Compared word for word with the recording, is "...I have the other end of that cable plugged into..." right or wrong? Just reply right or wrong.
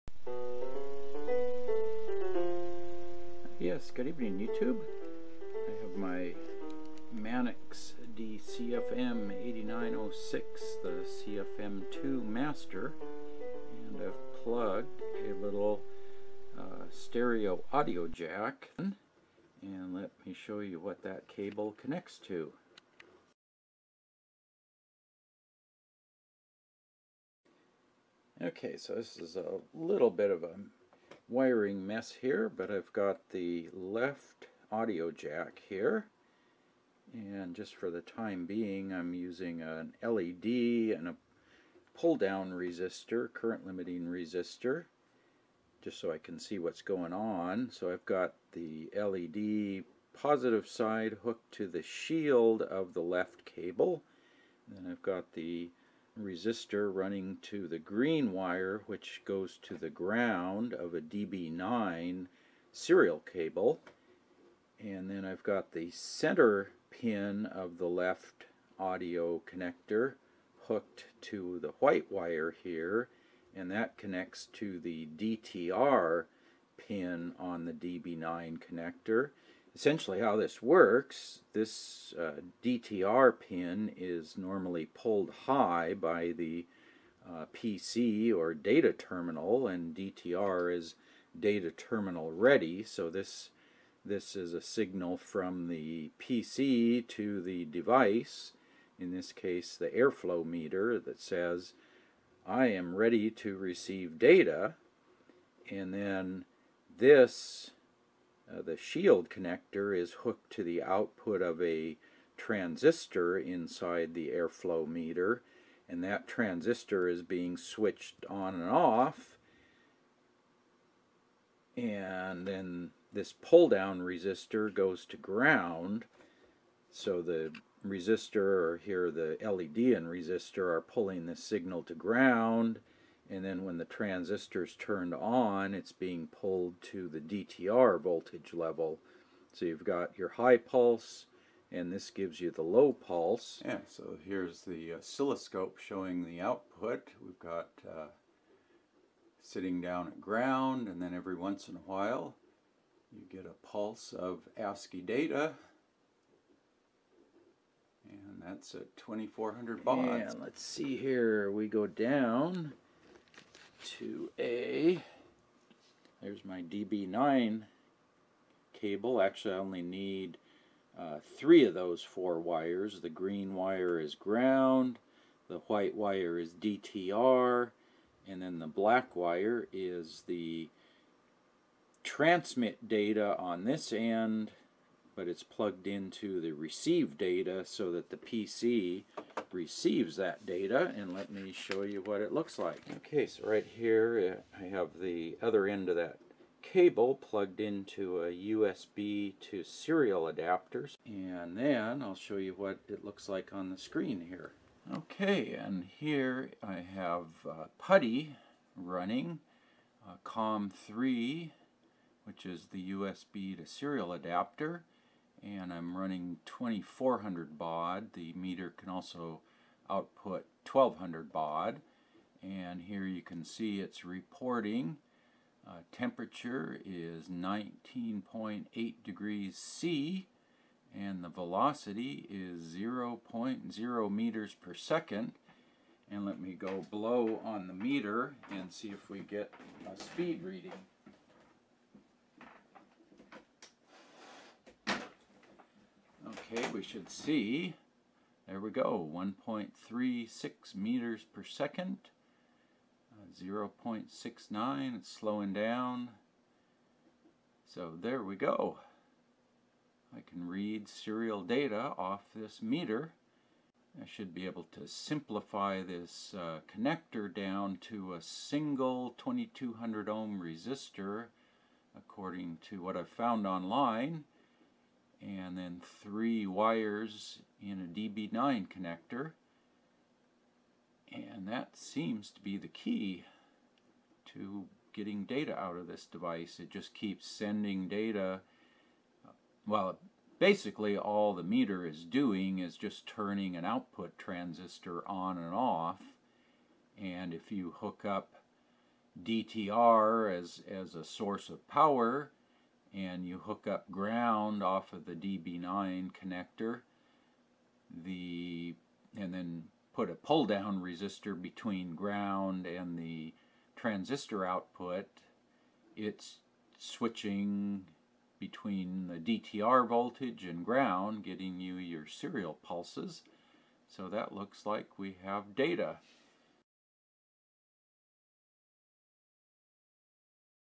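right.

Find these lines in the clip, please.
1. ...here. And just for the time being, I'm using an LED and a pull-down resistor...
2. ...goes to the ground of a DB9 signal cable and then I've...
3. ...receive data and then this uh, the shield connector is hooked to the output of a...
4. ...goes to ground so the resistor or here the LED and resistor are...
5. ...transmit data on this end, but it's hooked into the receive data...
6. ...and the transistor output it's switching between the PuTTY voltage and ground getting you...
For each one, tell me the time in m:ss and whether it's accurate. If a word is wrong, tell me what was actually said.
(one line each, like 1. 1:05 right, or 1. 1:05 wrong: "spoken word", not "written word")
1. 0:35 right
2. 0:59 wrong: "serial", not "signal"
3. 1:43 right
4. 2:04 right
5. 3:02 wrong: "plugged", not "hooked"
6. 5:12 wrong: "DTR", not "PuTTY".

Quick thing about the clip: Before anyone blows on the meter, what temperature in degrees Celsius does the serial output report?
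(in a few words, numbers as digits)
19.8.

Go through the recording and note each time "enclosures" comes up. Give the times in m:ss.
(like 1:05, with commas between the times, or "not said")
not said.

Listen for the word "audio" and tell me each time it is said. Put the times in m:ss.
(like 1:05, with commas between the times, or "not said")
0:17, 0:34, 1:08.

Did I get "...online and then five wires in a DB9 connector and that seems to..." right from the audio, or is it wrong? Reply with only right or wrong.
wrong.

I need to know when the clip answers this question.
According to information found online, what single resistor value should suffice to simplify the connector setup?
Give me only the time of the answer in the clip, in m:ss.
4:29.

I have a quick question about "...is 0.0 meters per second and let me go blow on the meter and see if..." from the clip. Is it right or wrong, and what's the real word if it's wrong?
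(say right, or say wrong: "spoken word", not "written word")
right.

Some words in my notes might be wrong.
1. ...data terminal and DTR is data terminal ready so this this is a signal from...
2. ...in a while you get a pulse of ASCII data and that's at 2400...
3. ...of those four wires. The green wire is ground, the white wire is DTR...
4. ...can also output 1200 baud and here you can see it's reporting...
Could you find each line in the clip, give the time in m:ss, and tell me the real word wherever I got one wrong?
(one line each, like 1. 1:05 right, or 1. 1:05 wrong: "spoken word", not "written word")
1. 1:28 right
2. 2:31 right
3. 2:51 right
4. 3:38 right.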